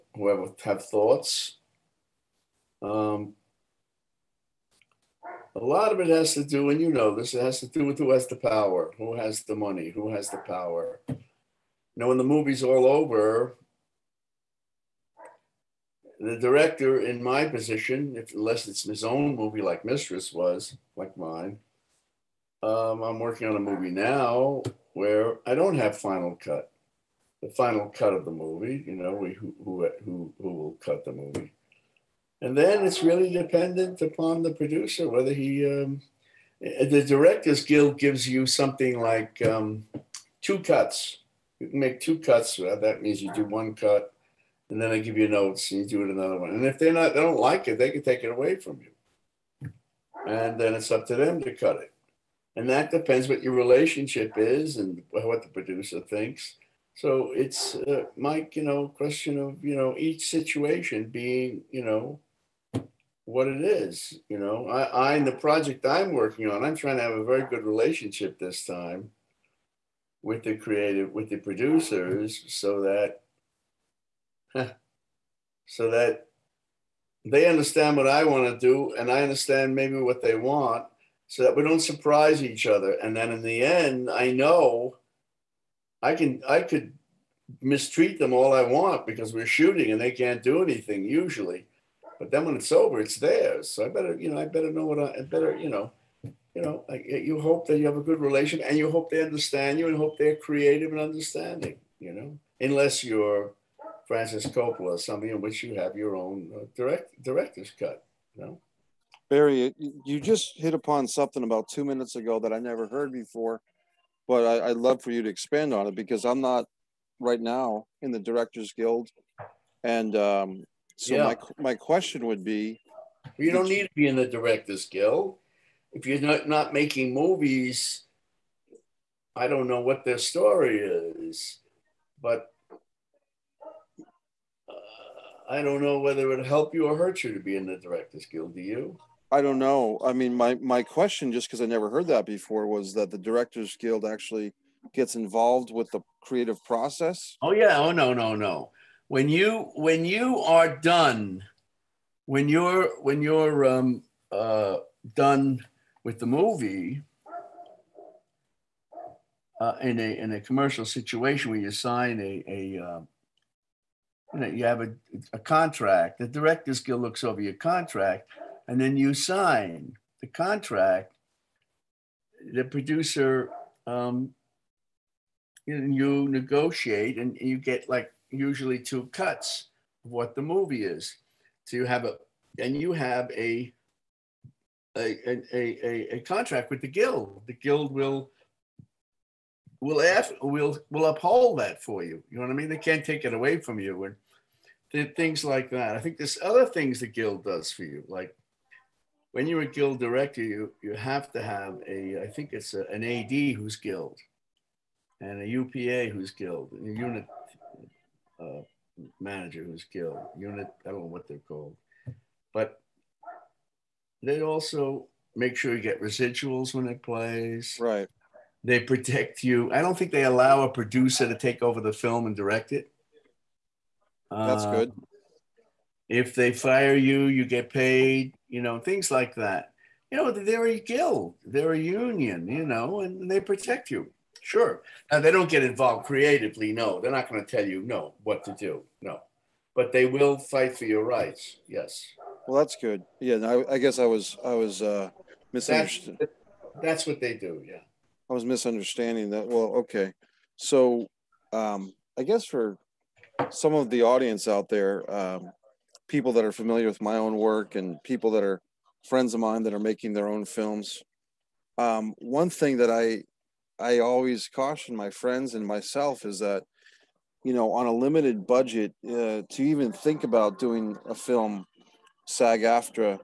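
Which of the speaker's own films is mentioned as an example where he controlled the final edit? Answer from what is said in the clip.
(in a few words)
Mistress.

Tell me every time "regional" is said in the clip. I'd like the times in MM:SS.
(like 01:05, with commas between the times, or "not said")
not said.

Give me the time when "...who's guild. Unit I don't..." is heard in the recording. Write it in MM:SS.
03:29.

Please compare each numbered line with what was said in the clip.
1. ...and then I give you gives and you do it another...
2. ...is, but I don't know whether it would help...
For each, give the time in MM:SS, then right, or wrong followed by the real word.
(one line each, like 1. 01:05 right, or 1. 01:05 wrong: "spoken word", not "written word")
1. 00:44 wrong: "notes", not "gives"
2. 02:10 right.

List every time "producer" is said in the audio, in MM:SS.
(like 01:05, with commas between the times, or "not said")
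00:34, 00:55, 01:11, 02:52, 03:40.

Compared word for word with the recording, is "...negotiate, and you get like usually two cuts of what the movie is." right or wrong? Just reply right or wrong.
right.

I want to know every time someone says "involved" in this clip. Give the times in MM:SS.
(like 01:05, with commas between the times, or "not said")
02:25, 03:55.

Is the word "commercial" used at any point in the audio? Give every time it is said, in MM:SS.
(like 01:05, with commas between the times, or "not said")
02:40.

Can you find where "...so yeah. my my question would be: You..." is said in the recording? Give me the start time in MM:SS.
02:00.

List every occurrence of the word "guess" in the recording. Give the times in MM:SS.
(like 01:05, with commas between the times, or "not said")
04:03, 04:12.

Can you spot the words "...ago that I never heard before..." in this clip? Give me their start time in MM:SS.
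01:52.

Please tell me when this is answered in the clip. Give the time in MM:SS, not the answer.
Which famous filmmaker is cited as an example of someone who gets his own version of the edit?
01:44.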